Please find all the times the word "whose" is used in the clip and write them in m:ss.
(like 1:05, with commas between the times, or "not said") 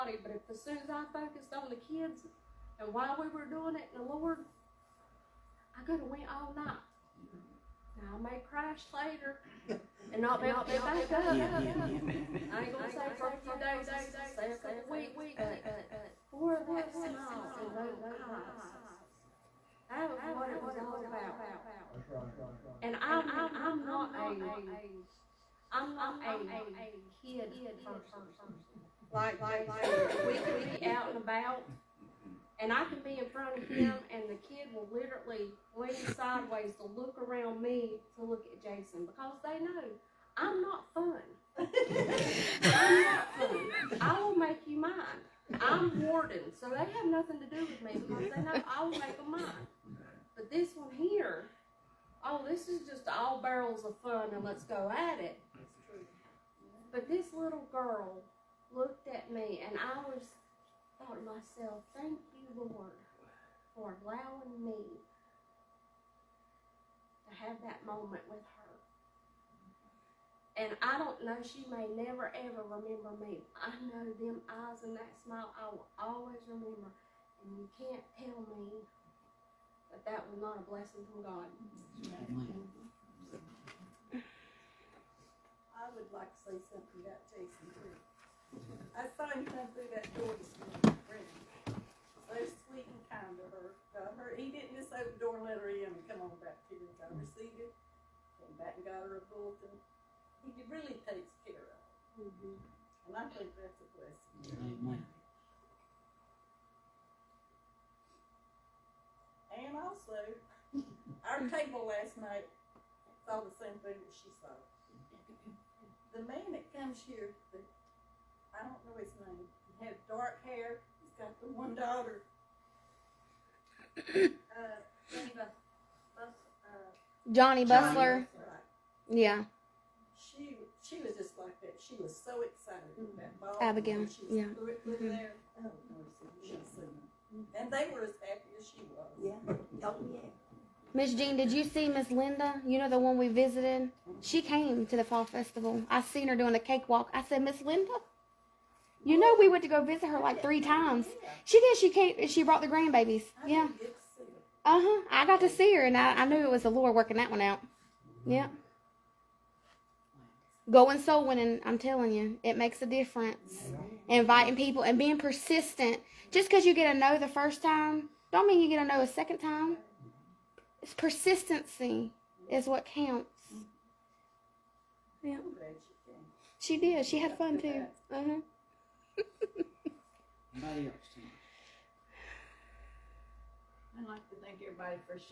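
not said.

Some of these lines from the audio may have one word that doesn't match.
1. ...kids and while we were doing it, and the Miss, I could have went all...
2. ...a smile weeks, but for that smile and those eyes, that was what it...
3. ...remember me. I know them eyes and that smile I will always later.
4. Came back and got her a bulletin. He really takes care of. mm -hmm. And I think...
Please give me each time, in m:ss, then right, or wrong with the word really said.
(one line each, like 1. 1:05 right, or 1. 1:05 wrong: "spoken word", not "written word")
1. 0:01 wrong: "Lord", not "Miss"
2. 0:14 wrong: "couple", not "smile"
3. 1:12 wrong: "remember", not "later"
4. 1:38 right.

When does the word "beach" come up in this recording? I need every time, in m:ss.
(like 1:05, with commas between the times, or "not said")
not said.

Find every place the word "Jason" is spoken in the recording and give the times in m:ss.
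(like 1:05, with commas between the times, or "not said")
0:29, 0:38, 1:27.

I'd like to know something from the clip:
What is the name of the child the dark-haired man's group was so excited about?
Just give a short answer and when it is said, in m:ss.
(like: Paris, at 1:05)
Abigail, at 2:13.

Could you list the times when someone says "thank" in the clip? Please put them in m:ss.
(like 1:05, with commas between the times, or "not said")
1:01, 3:04.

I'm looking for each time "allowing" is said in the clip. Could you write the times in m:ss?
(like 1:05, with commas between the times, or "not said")
1:04.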